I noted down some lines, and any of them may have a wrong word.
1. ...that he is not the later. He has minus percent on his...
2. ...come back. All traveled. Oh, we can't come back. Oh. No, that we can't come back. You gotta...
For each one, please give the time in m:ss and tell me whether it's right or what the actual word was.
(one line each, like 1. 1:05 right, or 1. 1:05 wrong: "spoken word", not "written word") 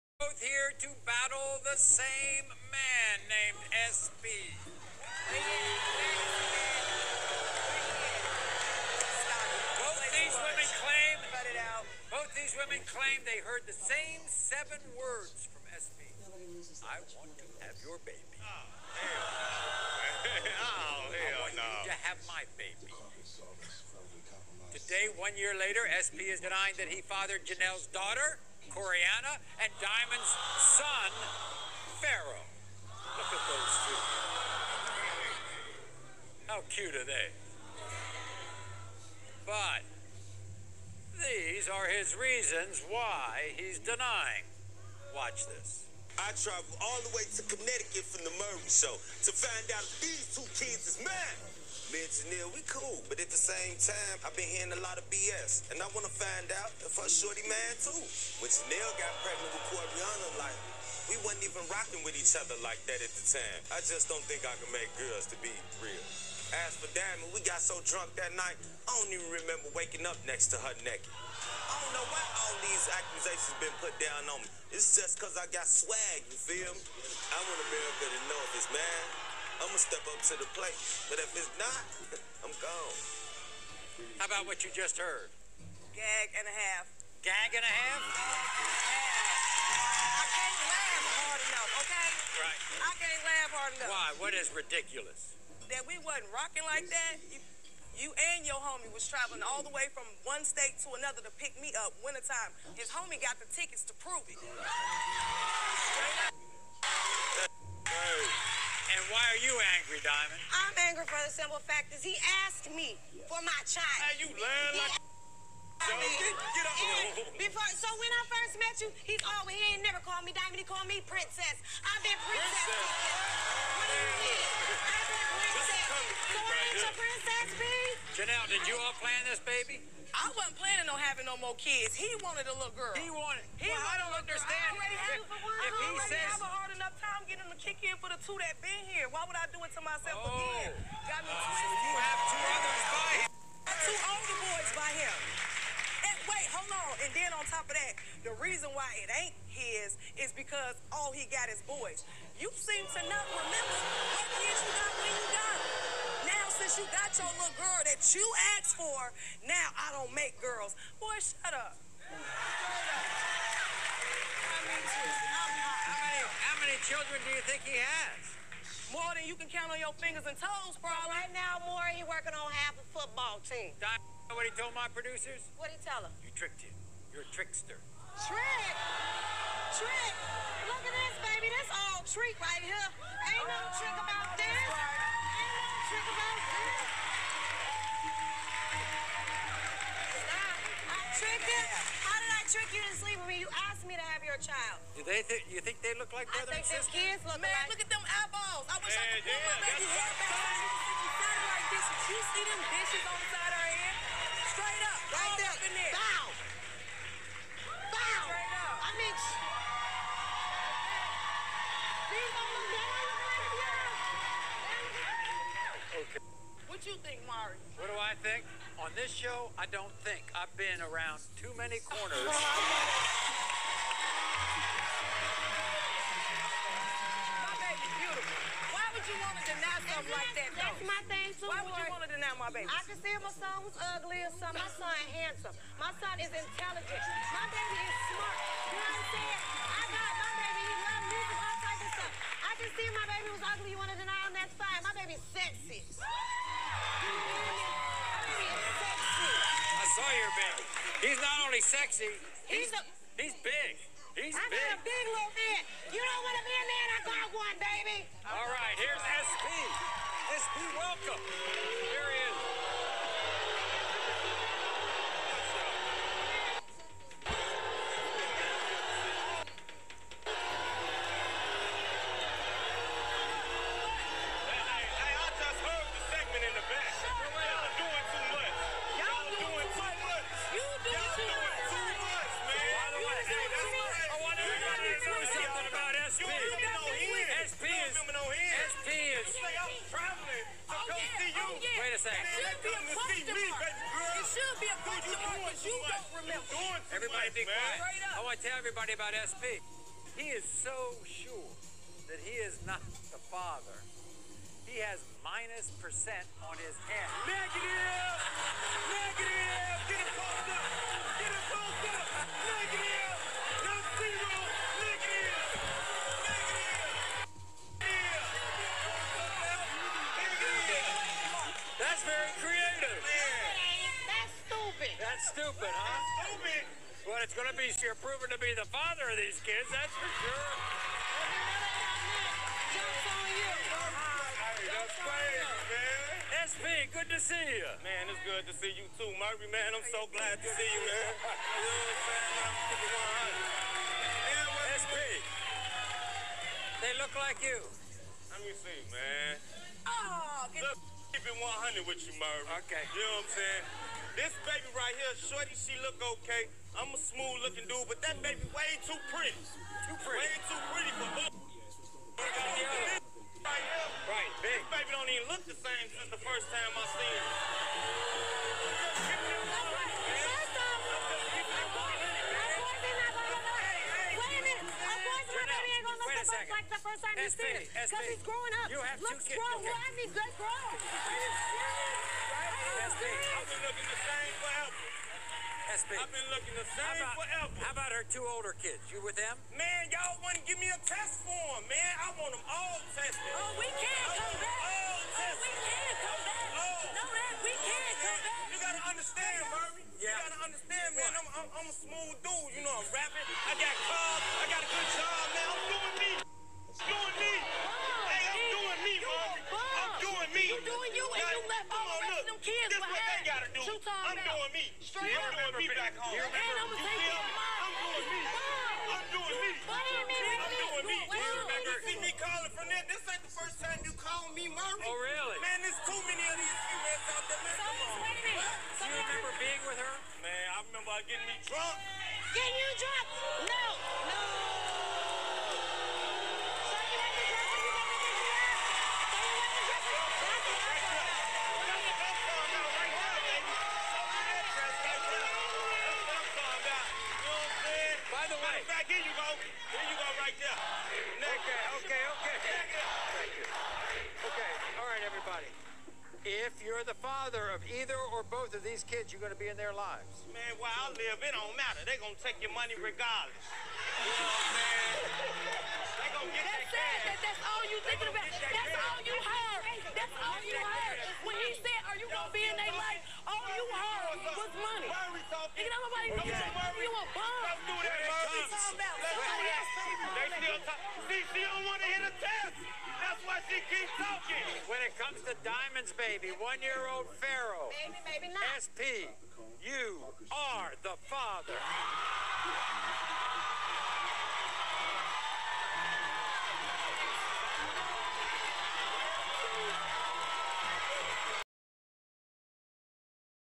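1. 5:02 wrong: "father", not "later"
2. 6:34 wrong: "tested", not "traveled".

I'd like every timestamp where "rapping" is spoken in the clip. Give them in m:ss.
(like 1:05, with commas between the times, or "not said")
6:42.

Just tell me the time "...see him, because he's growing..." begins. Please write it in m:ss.
6:17.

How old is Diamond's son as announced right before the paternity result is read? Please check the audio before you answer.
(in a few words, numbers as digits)
1.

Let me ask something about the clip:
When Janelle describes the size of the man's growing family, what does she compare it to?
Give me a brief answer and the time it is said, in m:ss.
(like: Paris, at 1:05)
half a football team, at 2:52.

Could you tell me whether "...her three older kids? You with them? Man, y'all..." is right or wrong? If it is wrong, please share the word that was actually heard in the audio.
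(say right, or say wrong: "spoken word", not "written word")
wrong: "two", not "three".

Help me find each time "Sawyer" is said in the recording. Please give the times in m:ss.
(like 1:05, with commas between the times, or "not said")
4:10.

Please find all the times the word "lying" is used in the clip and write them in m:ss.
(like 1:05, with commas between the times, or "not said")
1:54.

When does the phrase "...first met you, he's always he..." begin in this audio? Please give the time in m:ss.
1:58.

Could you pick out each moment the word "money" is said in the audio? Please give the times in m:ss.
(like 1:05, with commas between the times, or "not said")
7:42, 7:54.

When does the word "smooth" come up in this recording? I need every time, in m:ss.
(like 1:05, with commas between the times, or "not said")
5:56, 6:41.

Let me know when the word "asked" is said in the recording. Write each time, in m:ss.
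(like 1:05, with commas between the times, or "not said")
1:52, 2:38, 3:13.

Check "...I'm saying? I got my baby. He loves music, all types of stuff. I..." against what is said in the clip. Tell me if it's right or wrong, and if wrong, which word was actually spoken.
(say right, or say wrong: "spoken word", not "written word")
right.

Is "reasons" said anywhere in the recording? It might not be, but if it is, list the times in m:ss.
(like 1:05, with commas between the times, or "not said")
0:42, 2:28.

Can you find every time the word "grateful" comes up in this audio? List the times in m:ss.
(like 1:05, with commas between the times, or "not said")
not said.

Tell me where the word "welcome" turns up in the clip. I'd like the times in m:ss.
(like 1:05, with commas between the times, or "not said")
4:20.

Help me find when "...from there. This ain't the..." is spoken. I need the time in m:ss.
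7:02.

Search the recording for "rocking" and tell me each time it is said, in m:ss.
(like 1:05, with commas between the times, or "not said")
1:01, 1:36.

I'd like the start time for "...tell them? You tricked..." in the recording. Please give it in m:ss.
2:55.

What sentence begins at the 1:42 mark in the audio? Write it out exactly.
His homie got the tickets to prove it.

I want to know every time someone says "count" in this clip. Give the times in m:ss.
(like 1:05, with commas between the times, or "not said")
2:49.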